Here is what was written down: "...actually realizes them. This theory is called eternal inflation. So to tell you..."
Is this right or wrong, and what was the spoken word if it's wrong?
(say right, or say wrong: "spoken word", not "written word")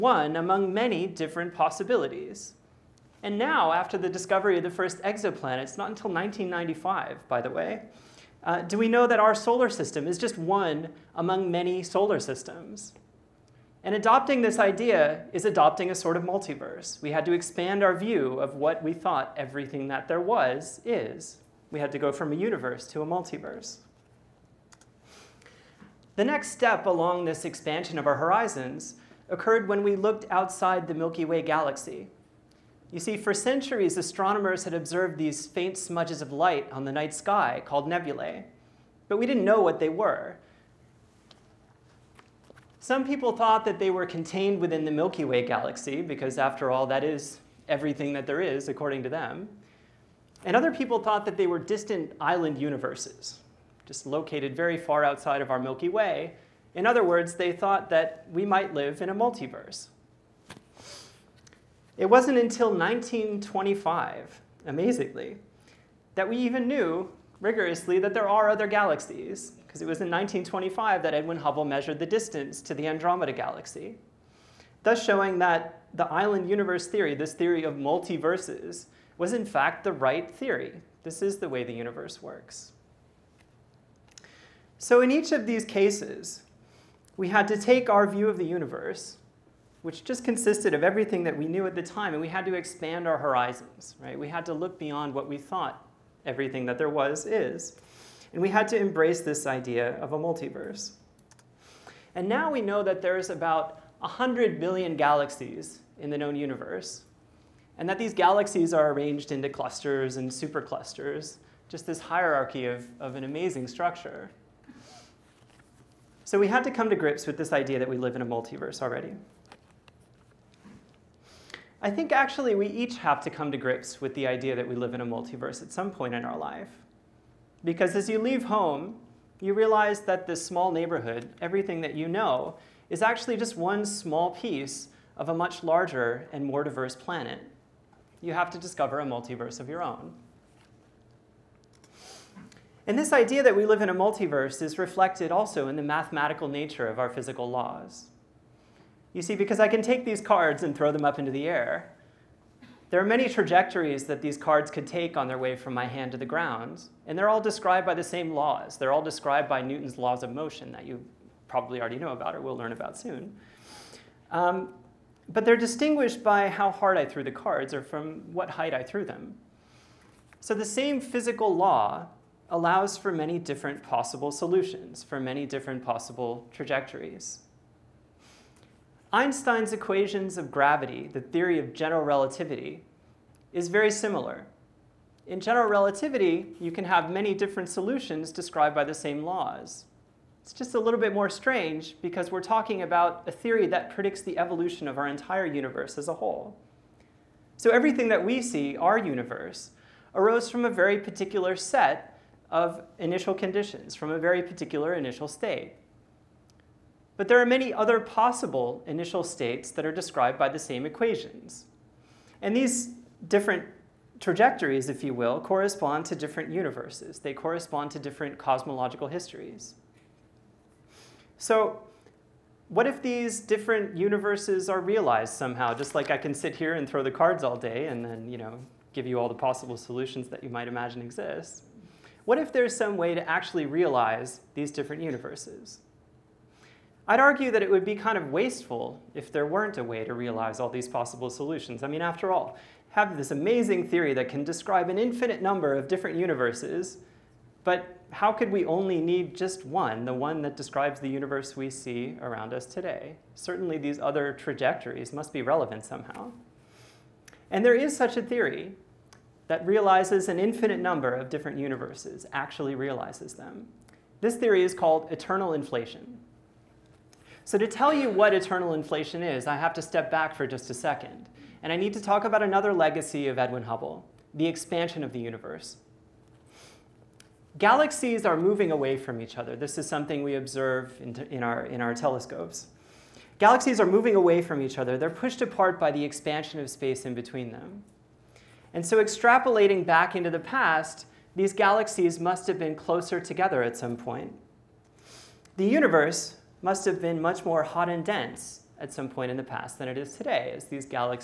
right.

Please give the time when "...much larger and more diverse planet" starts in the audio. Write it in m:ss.
2:15.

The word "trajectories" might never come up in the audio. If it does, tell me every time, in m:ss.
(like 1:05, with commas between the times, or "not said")
2:33, 2:56, 3:34, 4:14.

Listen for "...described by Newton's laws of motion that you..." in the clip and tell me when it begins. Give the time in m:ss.
2:39.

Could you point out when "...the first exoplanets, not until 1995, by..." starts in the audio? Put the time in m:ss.
0:04.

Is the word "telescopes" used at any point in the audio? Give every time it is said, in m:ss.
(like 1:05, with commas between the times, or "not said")
4:41.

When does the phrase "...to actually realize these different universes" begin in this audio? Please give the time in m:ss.
3:53.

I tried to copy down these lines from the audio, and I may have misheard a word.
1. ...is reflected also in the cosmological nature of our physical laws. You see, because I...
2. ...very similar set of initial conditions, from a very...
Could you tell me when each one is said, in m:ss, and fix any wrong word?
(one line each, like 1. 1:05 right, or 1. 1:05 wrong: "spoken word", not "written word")
1. 2:24 wrong: "mathematical", not "cosmological"
2. 3:20 wrong: "particular", not "similar".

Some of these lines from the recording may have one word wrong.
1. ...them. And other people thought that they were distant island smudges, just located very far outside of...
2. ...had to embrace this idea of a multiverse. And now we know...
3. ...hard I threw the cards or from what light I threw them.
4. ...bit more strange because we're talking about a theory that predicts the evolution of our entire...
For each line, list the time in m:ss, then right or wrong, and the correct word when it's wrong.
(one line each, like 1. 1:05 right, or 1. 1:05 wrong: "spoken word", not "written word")
1. 0:49 wrong: "universes", not "smudges"
2. 1:38 right
3. 2:46 wrong: "height", not "light"
4. 3:11 right.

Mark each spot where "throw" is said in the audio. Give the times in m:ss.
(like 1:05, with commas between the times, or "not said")
2:30, 3:46.